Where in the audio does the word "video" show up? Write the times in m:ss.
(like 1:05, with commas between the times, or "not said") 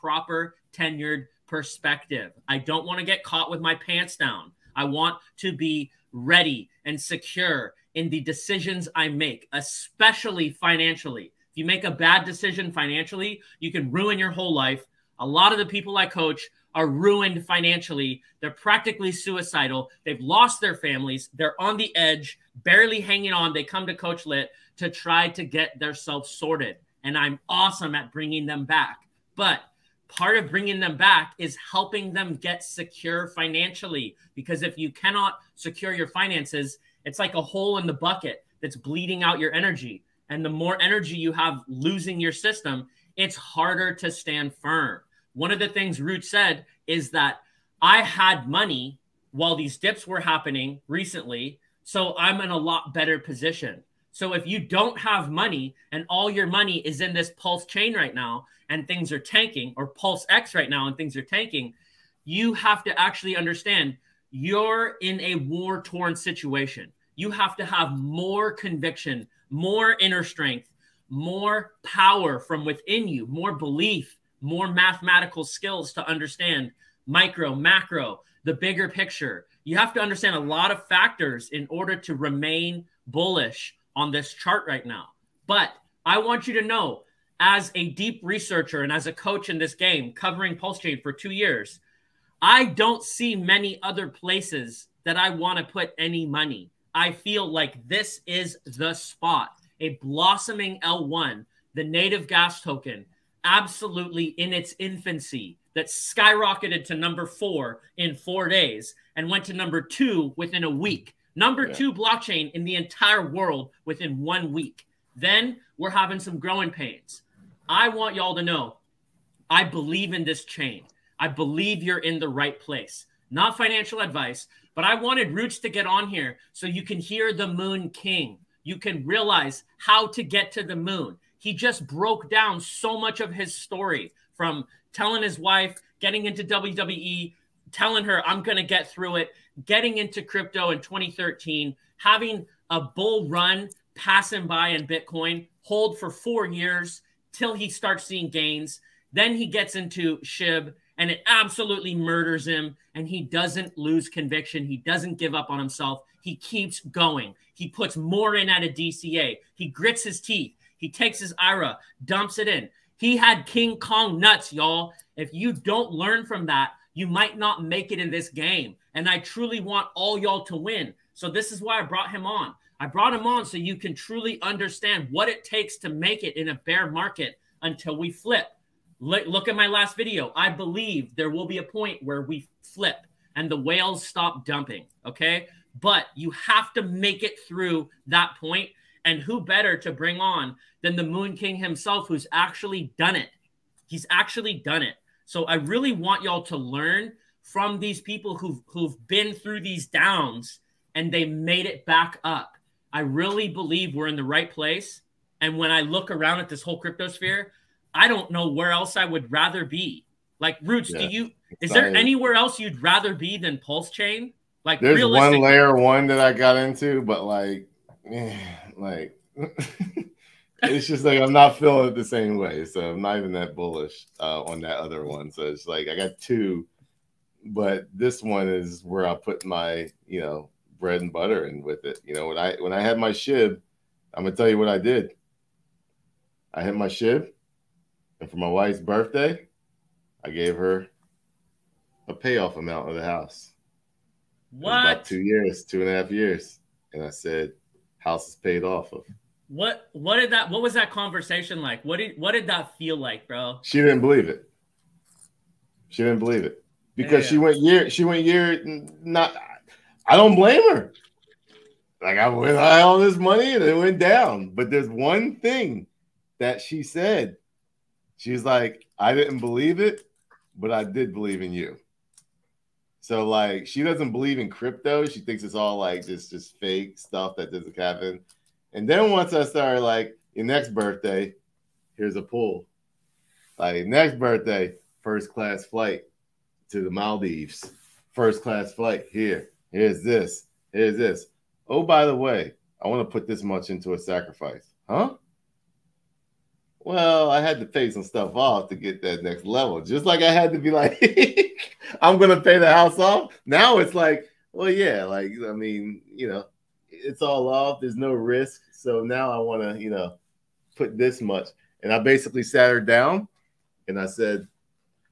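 2:59.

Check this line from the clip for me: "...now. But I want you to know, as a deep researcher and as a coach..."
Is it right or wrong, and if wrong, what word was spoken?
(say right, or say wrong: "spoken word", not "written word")
right.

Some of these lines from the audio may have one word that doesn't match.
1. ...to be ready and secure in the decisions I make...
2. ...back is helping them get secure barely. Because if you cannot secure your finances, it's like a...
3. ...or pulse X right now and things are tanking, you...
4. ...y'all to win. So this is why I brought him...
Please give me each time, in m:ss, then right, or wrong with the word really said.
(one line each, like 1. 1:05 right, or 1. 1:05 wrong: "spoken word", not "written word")
1. 0:05 right
2. 0:30 wrong: "financially", not "barely"
3. 0:59 right
4. 2:50 right.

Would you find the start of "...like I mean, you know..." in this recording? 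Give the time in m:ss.
5:05.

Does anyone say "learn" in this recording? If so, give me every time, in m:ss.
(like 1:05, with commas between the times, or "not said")
2:45, 3:16.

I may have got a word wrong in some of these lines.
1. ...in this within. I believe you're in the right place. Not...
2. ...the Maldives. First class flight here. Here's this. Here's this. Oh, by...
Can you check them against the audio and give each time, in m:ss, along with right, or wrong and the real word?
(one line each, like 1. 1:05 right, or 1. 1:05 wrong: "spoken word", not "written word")
1. 2:00 wrong: "chain", not "within"
2. 4:46 right.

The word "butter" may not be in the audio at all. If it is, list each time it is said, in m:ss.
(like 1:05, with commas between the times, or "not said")
3:51.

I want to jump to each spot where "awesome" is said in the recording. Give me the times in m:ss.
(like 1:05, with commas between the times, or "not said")
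0:27.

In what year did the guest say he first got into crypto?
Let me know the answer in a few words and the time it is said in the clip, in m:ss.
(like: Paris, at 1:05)
2013, at 2:20.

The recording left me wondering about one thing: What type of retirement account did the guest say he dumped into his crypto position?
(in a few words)
IRA.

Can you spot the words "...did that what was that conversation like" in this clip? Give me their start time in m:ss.
4:10.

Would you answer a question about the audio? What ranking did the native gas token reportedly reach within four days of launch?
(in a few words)
number 4.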